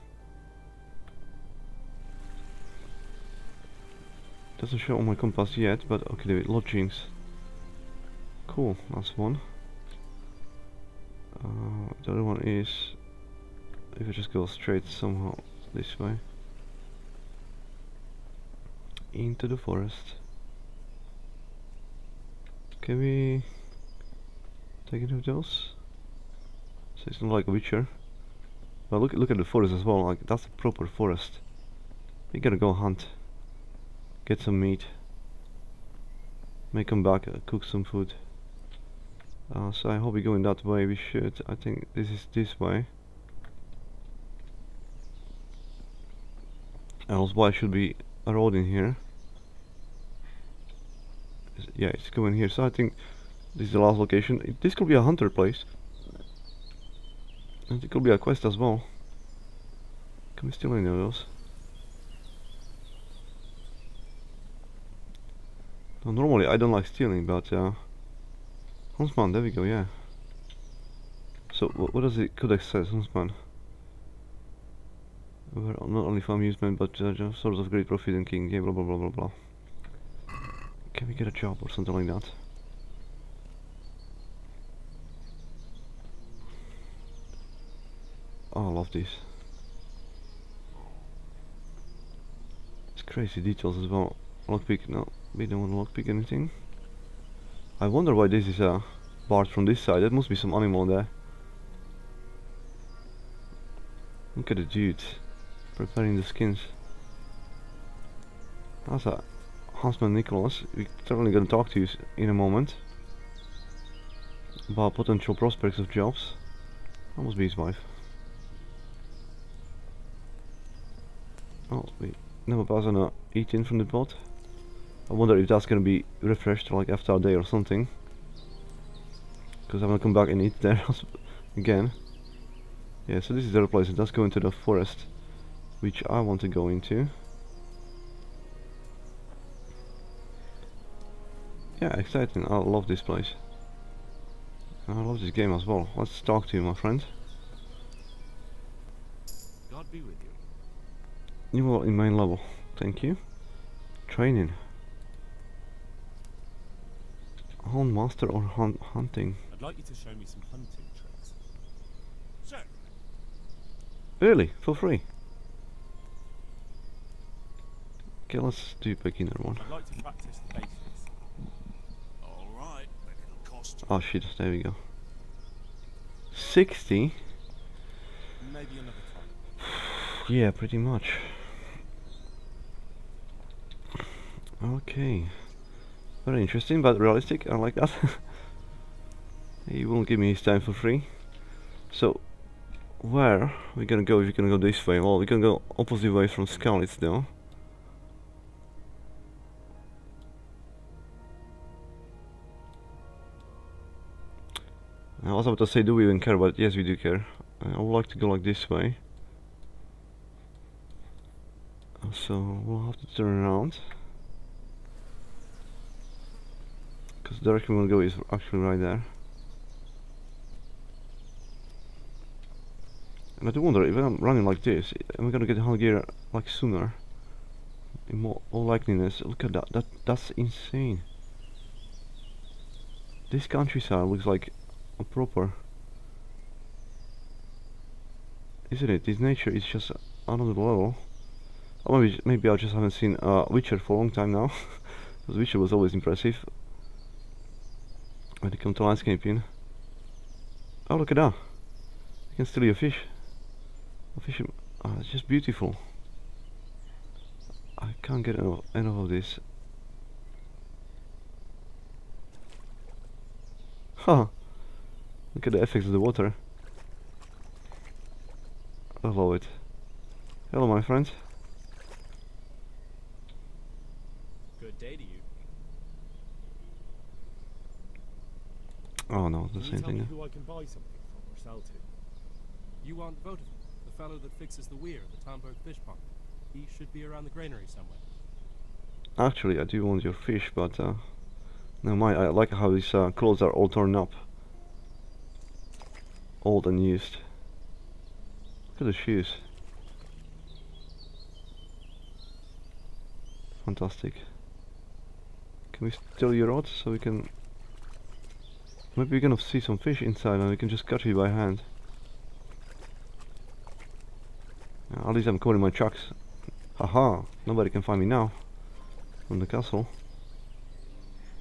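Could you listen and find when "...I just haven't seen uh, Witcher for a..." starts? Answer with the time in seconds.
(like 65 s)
242 s.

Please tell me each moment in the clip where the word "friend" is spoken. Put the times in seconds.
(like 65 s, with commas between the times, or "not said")
146 s, 270 s.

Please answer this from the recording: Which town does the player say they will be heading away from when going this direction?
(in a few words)
Skalitz.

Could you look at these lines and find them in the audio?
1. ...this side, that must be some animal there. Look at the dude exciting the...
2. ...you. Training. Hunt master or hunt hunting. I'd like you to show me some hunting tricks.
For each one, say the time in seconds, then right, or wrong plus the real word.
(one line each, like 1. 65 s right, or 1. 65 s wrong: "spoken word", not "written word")
1. 99 s wrong: "preparing", not "exciting"
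2. 153 s right.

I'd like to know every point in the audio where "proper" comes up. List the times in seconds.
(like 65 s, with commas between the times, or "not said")
30 s, 235 s.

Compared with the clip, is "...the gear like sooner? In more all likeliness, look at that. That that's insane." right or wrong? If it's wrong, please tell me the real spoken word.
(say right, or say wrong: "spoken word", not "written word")
right.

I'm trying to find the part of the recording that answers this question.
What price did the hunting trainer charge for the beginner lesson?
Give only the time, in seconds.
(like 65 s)
176 s.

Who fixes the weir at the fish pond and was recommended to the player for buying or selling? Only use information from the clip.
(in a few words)
Votivin.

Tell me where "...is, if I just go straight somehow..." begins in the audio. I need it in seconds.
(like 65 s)
12 s.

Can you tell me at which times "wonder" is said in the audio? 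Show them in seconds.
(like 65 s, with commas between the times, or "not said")
97 s, 125 s, 223 s.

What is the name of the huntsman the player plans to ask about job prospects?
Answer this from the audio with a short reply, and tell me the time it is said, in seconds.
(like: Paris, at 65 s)
Nicholas, at 110 s.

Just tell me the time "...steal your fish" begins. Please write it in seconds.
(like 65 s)
252 s.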